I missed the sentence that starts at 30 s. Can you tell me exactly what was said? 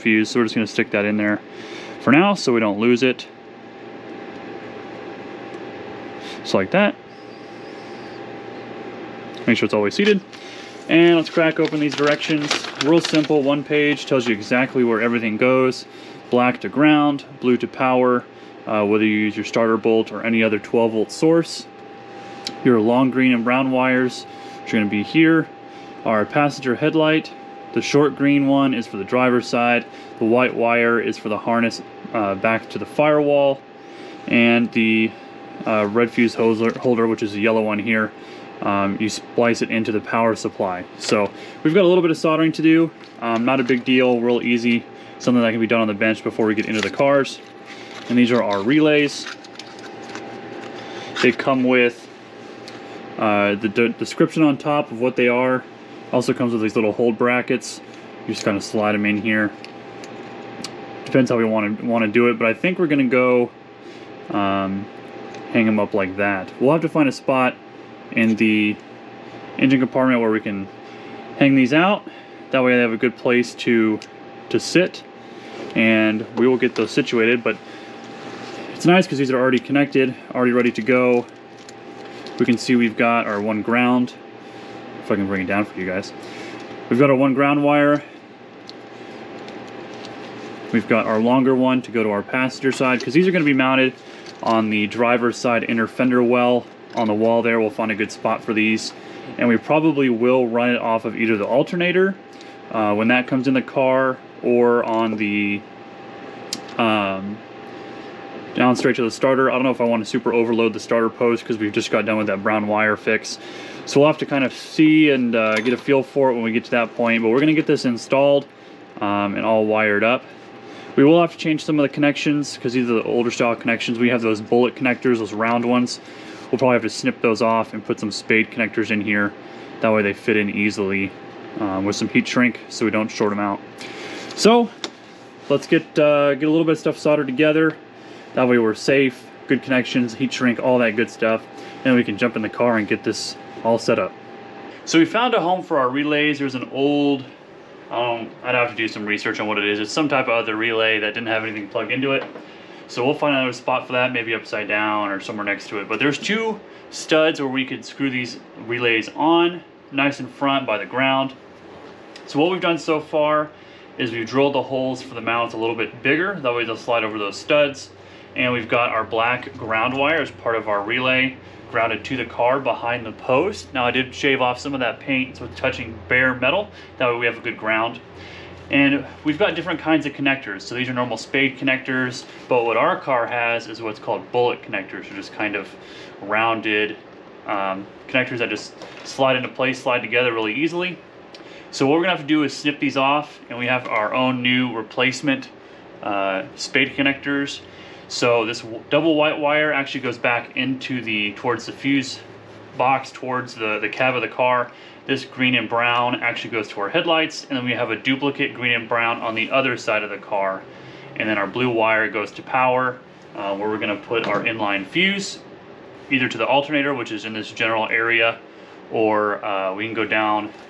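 The white wire is for the harness uh, back to the firewall.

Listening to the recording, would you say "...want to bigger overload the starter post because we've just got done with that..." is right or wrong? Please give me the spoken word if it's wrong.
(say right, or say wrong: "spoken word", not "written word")
wrong: "super", not "bigger".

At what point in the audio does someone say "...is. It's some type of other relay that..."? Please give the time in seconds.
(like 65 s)
149 s.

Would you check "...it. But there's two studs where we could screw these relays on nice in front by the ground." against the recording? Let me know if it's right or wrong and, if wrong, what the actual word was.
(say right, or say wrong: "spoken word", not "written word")
right.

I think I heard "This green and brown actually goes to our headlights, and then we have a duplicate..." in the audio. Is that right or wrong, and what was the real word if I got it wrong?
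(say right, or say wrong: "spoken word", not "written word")
right.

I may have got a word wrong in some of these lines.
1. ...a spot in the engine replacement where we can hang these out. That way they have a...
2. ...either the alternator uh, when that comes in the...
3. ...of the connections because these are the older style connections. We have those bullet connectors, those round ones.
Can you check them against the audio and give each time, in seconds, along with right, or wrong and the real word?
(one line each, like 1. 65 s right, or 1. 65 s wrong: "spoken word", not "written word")
1. 67 s wrong: "compartment", not "replacement"
2. 101 s right
3. 121 s right.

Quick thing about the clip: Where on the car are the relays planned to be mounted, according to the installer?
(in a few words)
Driver's side inner fender well.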